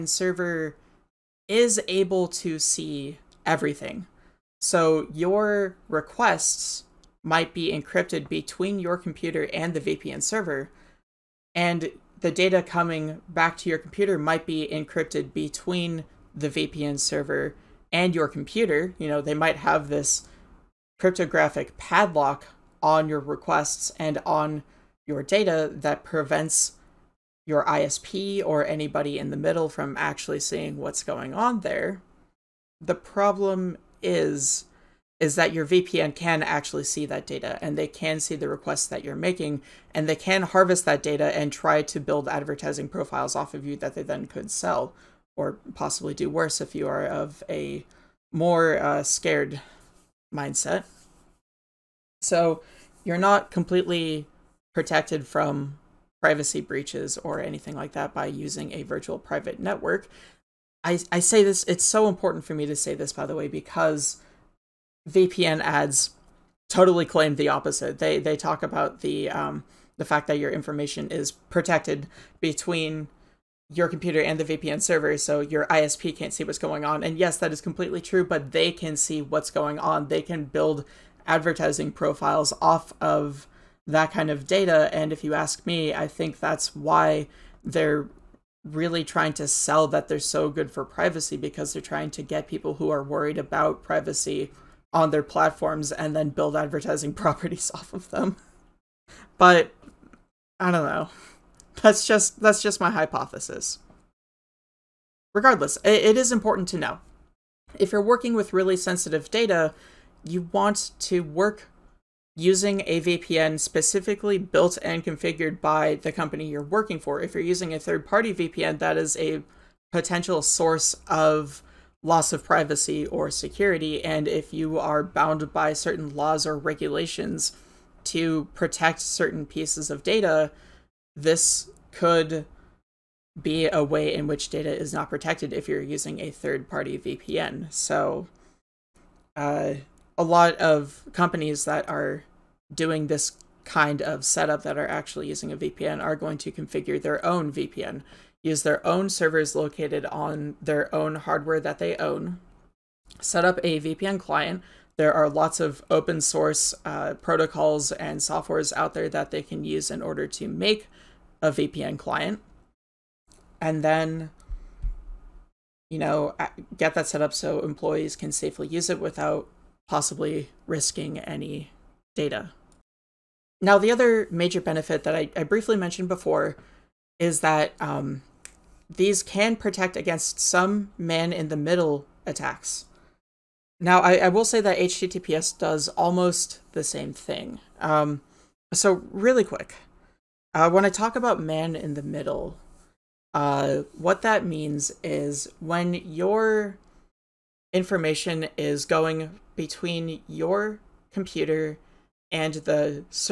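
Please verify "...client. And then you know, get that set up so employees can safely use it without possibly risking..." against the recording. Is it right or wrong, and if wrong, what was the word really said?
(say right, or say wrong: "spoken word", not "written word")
right.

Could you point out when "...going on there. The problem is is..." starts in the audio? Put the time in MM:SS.
00:31.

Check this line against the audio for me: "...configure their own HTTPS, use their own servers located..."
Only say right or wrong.
wrong.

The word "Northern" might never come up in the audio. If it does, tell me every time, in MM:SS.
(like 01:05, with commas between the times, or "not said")
not said.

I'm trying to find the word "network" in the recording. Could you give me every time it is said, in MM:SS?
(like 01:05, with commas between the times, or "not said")
00:59.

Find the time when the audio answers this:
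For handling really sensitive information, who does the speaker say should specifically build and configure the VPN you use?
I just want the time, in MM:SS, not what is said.
01:55.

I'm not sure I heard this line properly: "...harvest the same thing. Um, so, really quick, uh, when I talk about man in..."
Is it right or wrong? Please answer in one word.
wrong.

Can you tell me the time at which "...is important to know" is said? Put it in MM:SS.
01:46.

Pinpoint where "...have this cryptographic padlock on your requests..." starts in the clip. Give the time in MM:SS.
00:19.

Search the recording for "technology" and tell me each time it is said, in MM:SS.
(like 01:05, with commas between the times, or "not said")
not said.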